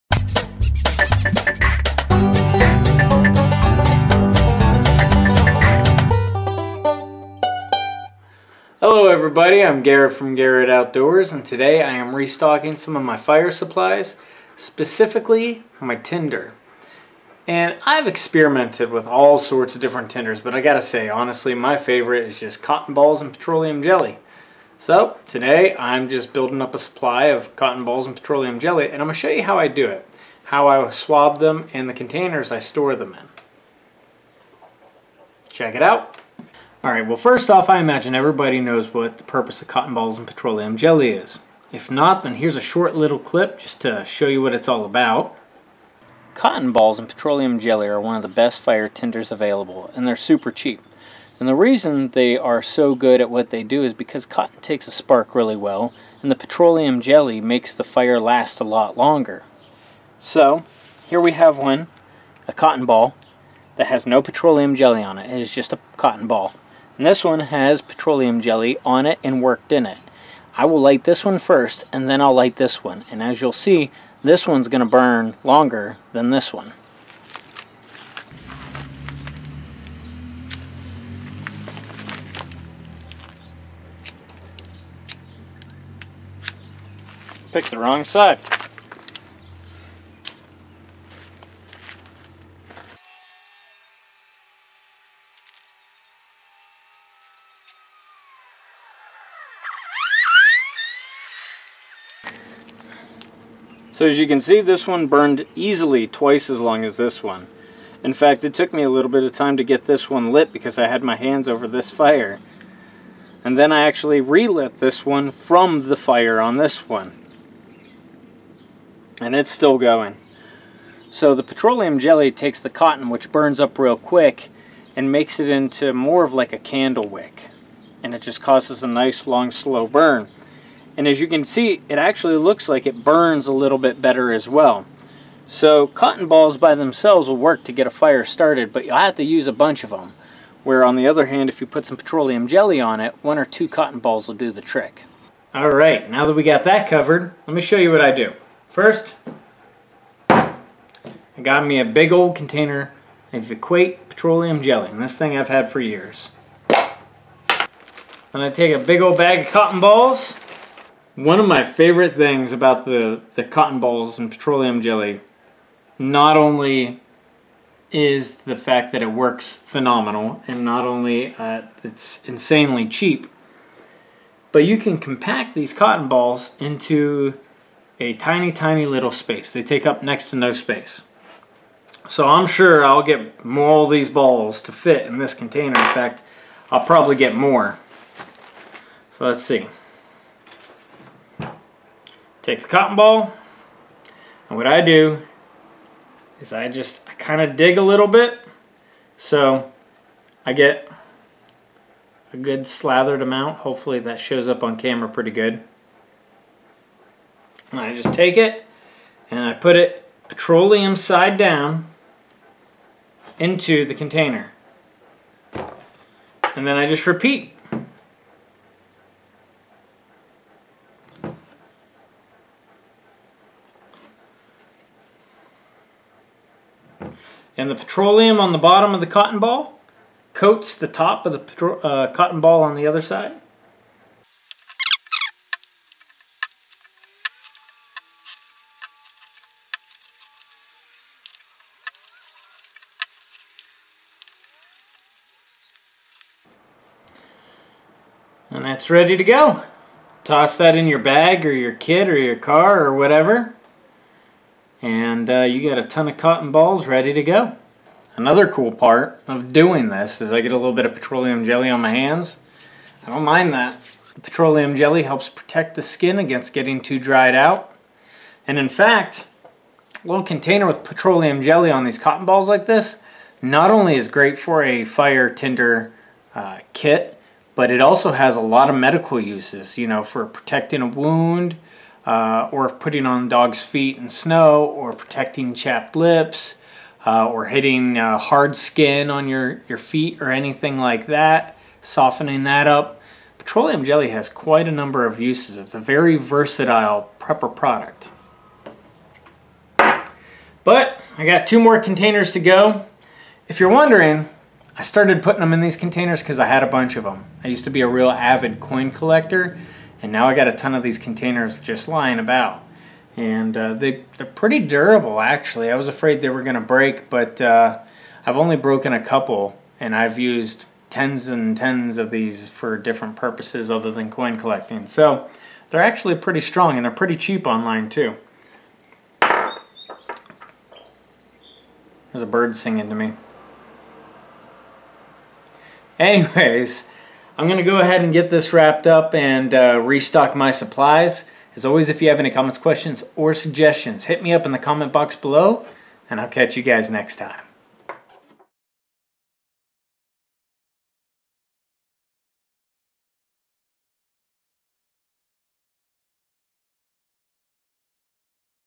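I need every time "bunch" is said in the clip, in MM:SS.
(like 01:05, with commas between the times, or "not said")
02:19, 05:06.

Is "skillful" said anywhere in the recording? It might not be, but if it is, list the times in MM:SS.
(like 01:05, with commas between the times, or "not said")
not said.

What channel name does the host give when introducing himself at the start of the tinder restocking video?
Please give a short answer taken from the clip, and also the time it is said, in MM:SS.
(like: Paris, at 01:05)
Gerret Outdoors, at 00:10.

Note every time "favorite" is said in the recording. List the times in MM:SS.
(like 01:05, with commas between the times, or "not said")
00:21, 02:41.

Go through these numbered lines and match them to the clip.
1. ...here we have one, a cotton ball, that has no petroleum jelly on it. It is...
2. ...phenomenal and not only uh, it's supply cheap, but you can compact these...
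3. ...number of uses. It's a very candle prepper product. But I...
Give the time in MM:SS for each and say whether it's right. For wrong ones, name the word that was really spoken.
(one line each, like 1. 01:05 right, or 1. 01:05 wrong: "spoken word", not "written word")
1. 01:01 right
2. 02:49 wrong: "insanely", not "supply"
3. 04:54 wrong: "versatile", not "candle".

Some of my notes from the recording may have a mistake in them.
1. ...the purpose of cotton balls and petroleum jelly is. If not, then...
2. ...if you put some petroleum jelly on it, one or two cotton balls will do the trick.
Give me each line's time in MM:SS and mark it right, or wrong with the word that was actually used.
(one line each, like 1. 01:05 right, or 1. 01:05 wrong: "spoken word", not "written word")
1. 00:39 right
2. 02:21 right.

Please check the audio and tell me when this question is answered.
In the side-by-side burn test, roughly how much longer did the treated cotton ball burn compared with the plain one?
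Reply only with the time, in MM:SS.
01:46.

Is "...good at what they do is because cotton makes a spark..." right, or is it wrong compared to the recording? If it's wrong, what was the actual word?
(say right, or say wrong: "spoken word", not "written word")
wrong: "takes", not "makes".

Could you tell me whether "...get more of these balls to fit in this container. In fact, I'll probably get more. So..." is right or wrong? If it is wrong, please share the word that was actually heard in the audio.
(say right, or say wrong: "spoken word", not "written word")
right.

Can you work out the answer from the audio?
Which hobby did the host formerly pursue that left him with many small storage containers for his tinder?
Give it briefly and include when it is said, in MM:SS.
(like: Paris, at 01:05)
coin collecting, at 05:08.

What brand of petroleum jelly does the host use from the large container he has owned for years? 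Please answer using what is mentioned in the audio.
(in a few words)
Equate.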